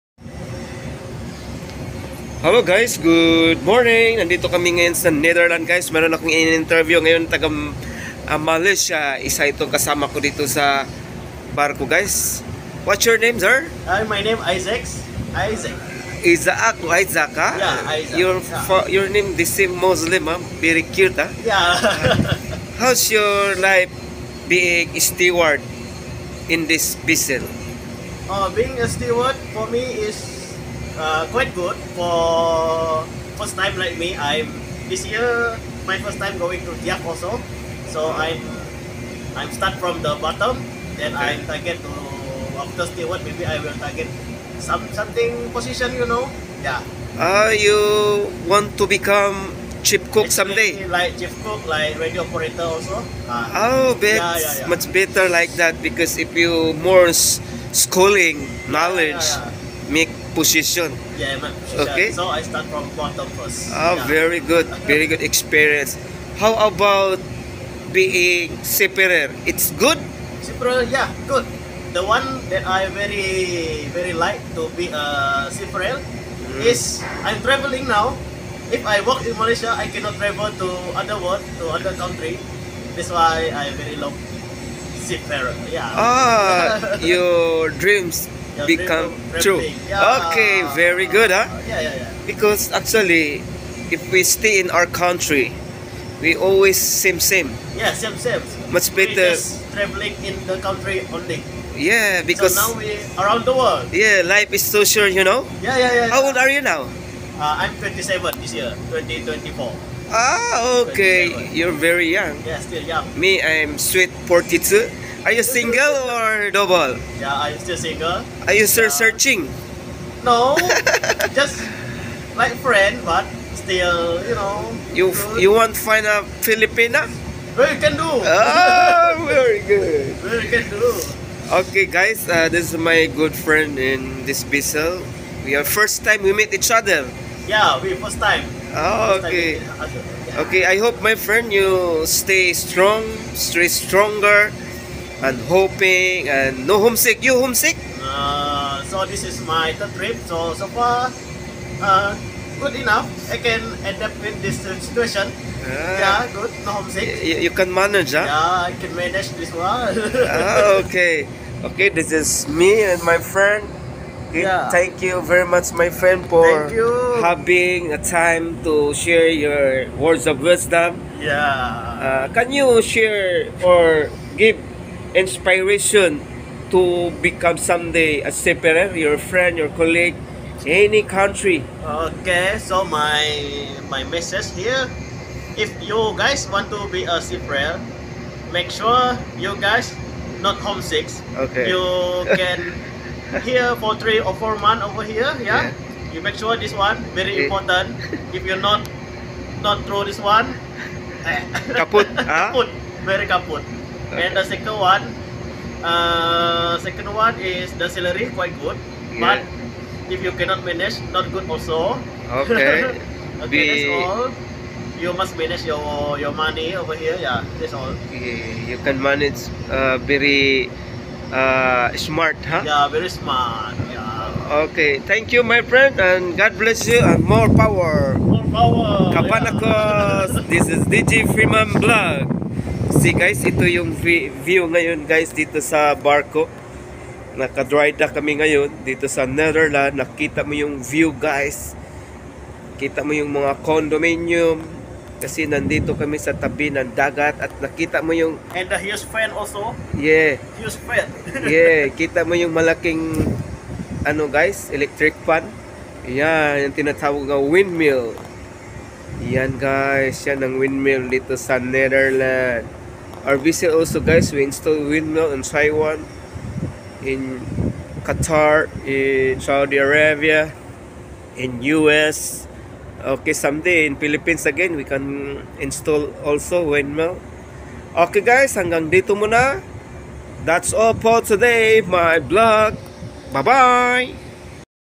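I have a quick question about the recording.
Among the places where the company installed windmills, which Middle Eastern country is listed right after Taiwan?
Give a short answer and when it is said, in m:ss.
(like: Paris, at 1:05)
Qatar, at 4:28.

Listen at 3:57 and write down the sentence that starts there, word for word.
Naka-dry dock kami ngayon dito sa Netherlands.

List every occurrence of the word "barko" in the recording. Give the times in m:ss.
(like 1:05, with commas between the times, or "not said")
0:11, 3:55.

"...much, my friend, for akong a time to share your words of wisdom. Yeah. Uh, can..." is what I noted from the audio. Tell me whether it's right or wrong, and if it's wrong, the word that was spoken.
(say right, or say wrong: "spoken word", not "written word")
wrong: "having", not "akong".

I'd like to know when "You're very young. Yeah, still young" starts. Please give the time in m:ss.
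1:51.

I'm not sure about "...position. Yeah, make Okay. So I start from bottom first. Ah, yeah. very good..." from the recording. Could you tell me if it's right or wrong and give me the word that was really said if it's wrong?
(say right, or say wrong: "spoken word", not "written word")
right.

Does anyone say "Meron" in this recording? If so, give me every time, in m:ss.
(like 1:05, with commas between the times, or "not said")
0:05.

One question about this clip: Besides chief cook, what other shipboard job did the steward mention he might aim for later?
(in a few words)
Radio operator.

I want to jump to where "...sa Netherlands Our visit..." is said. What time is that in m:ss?
4:21.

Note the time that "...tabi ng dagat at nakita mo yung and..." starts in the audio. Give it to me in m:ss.
4:06.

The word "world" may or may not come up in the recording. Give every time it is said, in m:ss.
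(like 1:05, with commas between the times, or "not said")
1:21, 1:43.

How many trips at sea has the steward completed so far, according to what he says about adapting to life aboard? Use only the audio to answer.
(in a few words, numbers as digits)
Third trip.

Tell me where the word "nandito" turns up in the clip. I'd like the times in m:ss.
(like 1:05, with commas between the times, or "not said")
0:04, 4:05.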